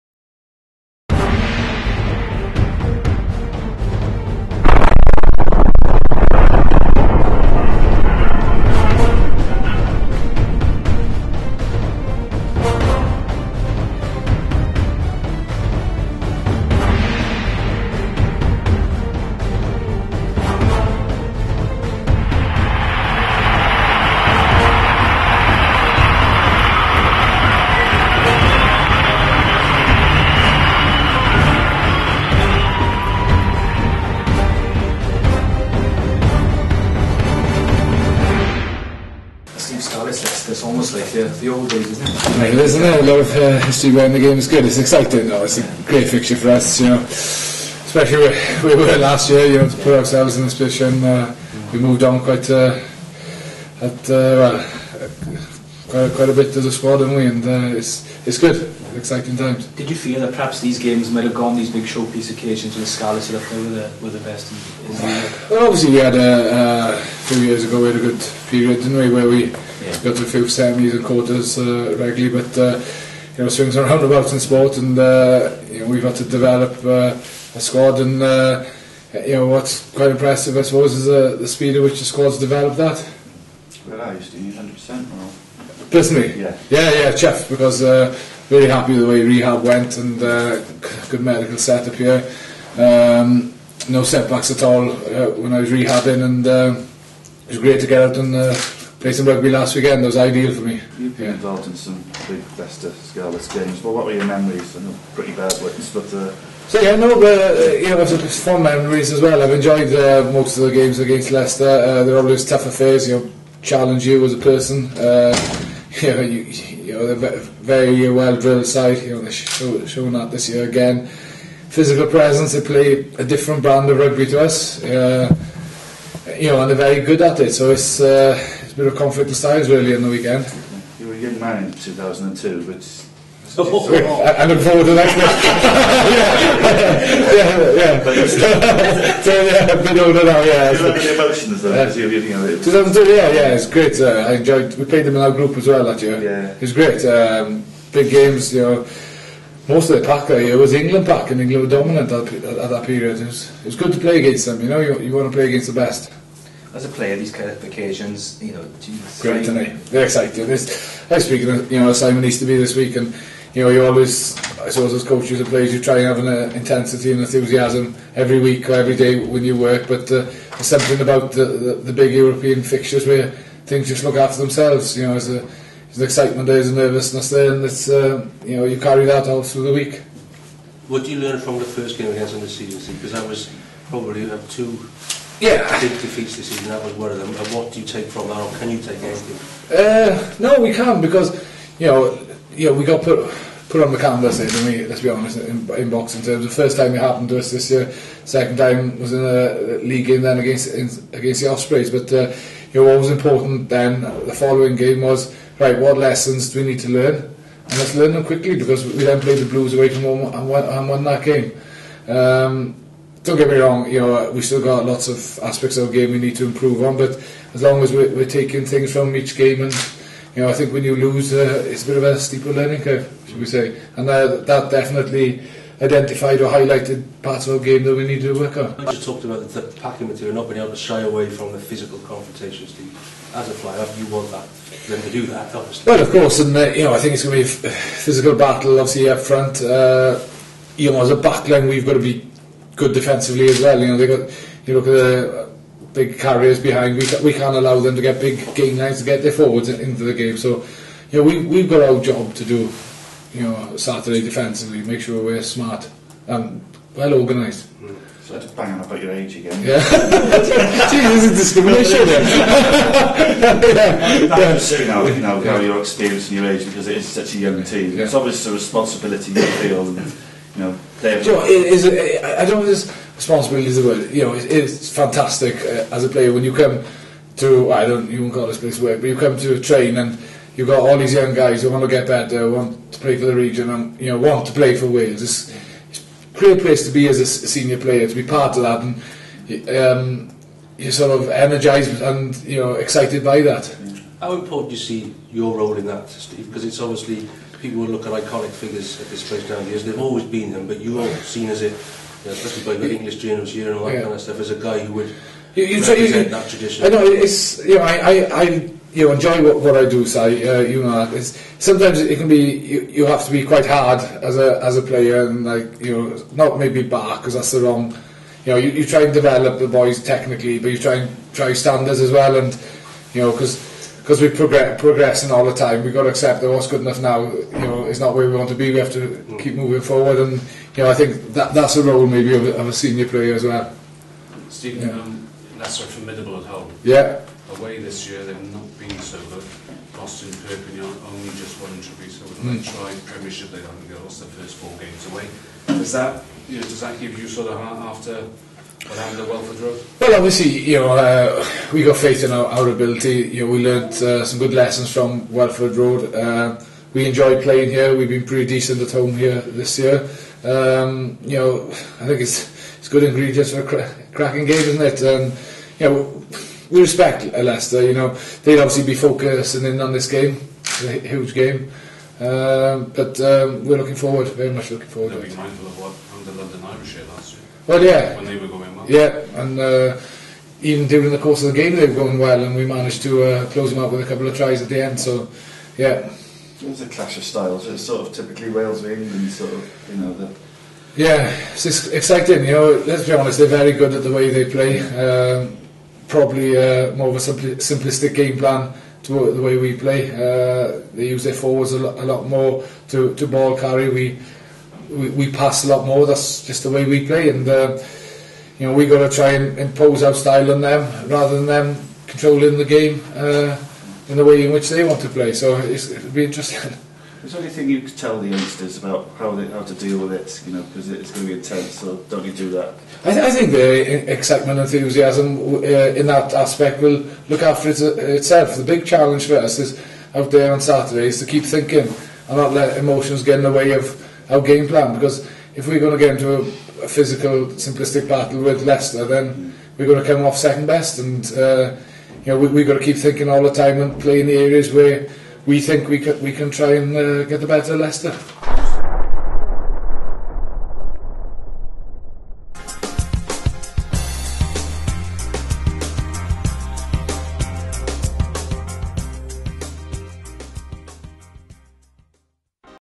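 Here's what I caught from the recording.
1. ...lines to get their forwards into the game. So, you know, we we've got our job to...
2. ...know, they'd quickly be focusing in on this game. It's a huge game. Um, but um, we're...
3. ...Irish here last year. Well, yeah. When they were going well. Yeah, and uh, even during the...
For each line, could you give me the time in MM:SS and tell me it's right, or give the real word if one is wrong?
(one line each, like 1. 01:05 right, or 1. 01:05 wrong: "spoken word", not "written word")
1. 04:08 right
2. 06:07 wrong: "obviously", not "quickly"
3. 06:16 right.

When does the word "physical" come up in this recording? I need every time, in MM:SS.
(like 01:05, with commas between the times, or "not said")
02:01, 03:51, 03:57, 07:16.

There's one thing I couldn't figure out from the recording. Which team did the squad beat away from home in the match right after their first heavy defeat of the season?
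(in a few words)
Blues.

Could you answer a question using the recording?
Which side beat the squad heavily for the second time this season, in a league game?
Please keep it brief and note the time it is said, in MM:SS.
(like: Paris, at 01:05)
Ospreys, at 03:21.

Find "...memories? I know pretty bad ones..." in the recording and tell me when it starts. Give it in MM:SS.
01:44.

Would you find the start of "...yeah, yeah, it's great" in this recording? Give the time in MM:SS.
02:23.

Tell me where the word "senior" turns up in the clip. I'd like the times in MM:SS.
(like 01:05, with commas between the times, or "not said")
04:47, 05:32.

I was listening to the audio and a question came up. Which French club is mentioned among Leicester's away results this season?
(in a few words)
Perpignan.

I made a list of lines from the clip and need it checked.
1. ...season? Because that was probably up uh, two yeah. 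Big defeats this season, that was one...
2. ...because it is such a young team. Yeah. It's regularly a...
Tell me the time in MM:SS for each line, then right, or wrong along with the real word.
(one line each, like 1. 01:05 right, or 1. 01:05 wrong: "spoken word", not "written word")
1. 03:02 right
2. 04:26 wrong: "obviously", not "regularly".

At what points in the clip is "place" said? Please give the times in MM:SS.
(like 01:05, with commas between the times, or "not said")
04:38, 04:46, 04:59.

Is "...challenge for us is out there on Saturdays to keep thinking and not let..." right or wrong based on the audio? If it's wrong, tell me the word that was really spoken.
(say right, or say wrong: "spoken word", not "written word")
right.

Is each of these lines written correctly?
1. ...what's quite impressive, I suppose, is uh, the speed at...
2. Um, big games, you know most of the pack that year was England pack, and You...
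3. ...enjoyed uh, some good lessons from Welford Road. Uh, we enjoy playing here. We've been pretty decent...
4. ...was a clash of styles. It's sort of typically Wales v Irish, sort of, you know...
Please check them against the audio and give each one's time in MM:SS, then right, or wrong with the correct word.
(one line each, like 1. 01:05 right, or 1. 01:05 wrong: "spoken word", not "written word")
1. 01:19 right
2. 02:27 wrong: "England", not "You"
3. 05:53 wrong: "learned", not "enjoyed"
4. 06:26 wrong: "England", not "Irish".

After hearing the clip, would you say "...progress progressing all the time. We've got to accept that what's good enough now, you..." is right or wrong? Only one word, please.
right.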